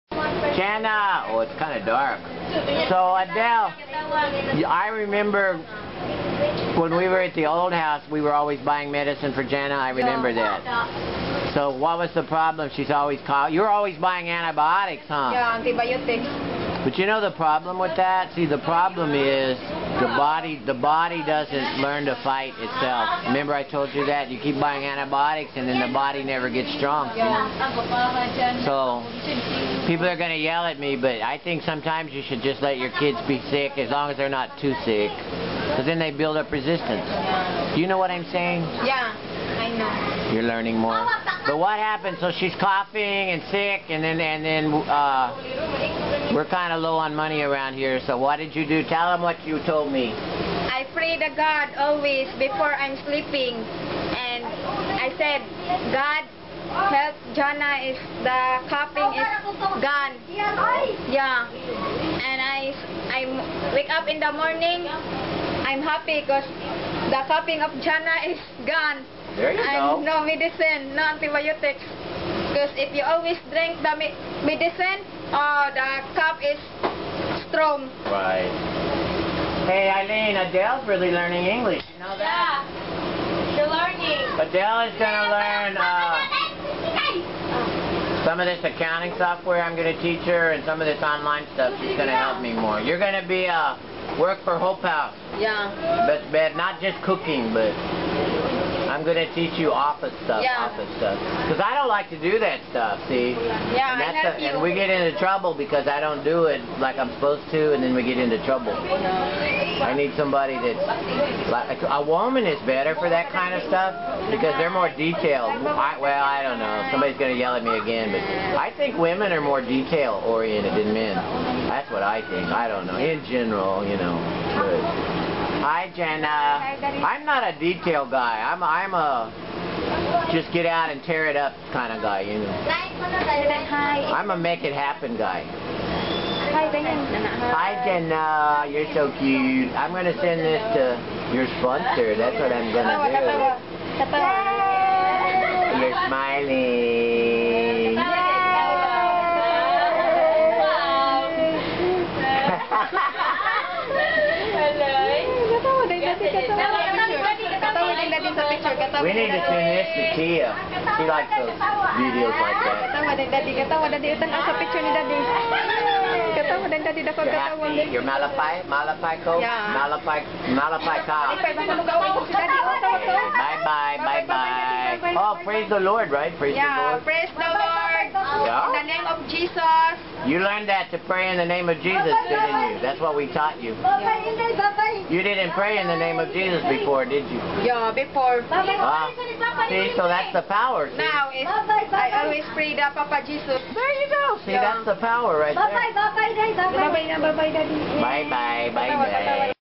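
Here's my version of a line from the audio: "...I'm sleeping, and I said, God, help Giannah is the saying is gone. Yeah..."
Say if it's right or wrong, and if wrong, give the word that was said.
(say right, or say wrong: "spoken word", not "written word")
wrong: "coughing", not "saying".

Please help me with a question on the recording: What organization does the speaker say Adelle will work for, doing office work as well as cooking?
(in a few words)
Hope House.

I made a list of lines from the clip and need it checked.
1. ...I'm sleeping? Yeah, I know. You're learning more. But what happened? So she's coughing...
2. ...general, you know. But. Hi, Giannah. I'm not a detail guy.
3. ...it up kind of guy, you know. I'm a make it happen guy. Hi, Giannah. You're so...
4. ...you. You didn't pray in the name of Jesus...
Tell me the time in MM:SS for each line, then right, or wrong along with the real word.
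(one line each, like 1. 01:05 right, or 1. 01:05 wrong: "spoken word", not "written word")
1. 00:38 wrong: "saying", not "sleeping"
2. 02:03 right
3. 02:11 right
4. 03:03 right.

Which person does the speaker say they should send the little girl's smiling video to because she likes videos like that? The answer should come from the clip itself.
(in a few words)
Tia.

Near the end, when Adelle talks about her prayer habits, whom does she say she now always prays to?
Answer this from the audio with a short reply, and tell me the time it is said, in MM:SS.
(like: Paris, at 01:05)
Papa Jesus, at 03:12.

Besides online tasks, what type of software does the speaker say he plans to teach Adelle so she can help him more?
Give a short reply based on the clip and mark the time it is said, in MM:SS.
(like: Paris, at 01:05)
accounting software, at 01:28.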